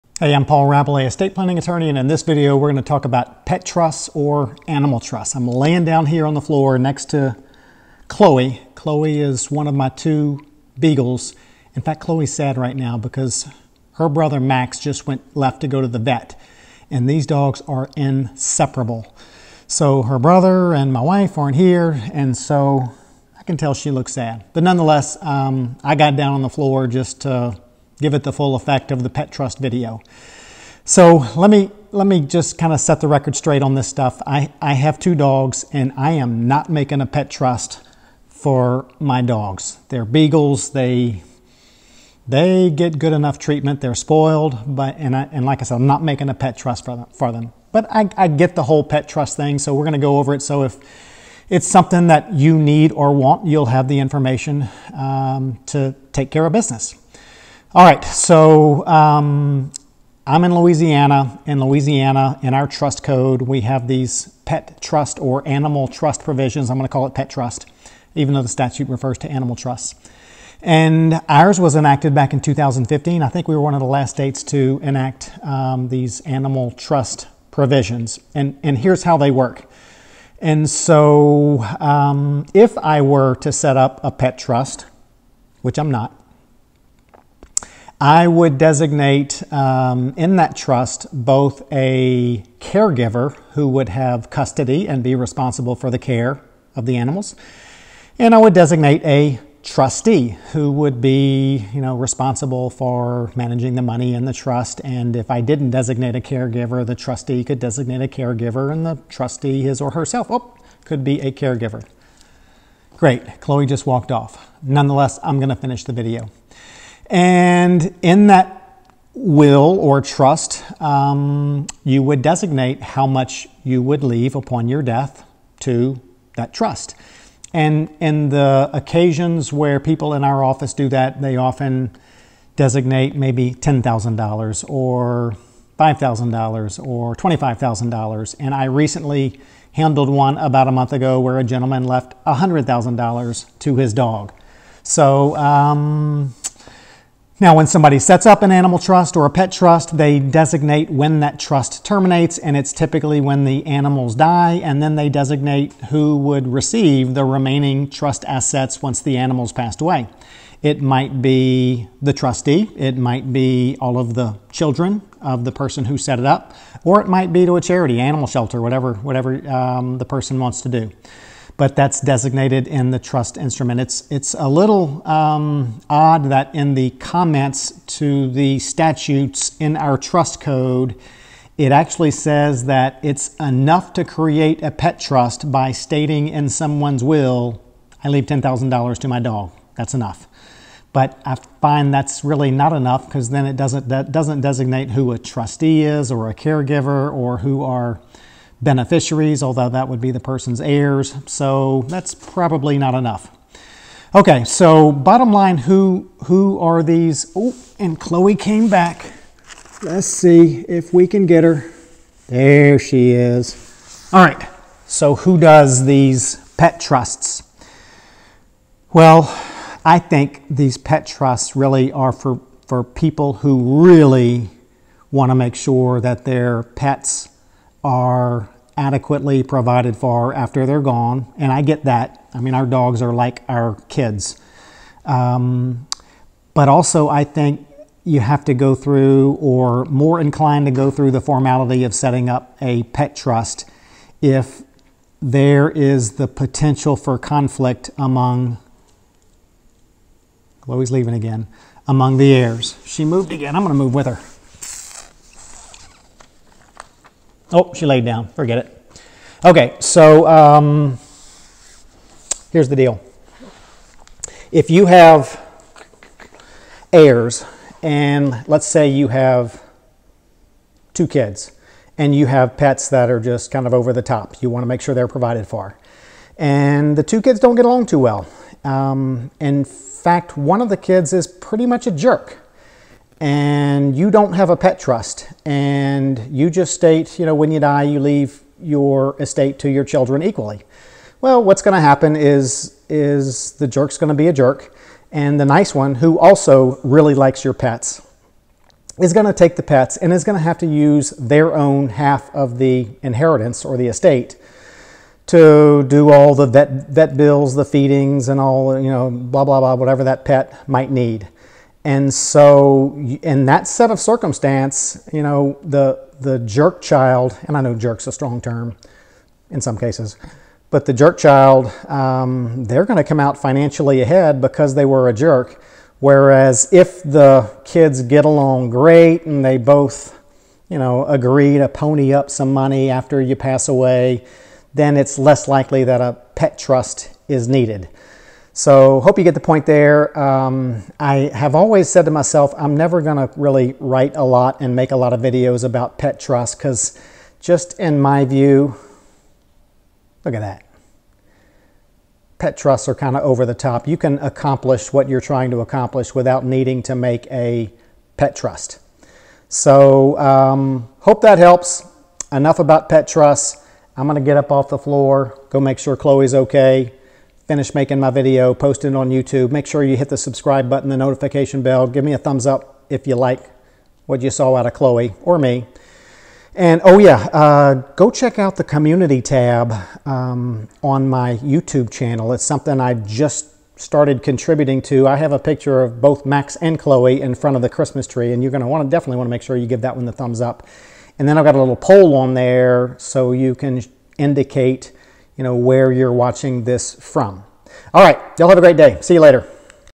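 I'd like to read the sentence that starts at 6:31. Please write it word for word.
And then I've got a little poll on there so you can indicate you know, where you're watching this from.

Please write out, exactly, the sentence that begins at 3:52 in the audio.
I mean, our dogs are like our kids.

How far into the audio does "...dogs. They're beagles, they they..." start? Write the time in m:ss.
0:39.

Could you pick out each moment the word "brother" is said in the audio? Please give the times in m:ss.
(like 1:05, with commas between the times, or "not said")
0:14, 0:20.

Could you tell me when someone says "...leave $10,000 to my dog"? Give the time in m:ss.
3:08.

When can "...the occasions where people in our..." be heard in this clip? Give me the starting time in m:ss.
2:08.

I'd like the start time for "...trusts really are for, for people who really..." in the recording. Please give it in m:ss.
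3:41.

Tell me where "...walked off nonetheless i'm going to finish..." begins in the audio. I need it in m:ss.
1:53.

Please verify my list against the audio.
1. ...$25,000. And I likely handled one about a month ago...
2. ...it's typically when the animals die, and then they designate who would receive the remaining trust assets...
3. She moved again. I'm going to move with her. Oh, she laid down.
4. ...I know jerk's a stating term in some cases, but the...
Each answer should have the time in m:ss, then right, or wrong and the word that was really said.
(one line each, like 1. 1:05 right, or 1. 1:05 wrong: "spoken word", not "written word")
1. 2:17 wrong: "recently", not "likely"
2. 2:32 right
3. 4:12 right
4. 5:17 wrong: "strong", not "stating".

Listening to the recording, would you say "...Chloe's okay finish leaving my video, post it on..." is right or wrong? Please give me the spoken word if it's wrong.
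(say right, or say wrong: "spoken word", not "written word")
wrong: "making", not "leaving".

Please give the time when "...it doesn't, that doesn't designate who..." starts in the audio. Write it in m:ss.
3:13.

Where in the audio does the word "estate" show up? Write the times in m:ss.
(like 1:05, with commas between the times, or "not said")
0:01, 4:49, 5:03.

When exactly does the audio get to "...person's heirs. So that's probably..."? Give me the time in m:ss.
3:20.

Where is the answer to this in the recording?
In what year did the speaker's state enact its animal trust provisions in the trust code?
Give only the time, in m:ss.
1:12.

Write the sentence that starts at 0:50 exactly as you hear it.
So if it's something that you need or want, you'll have the information um, to take care of business.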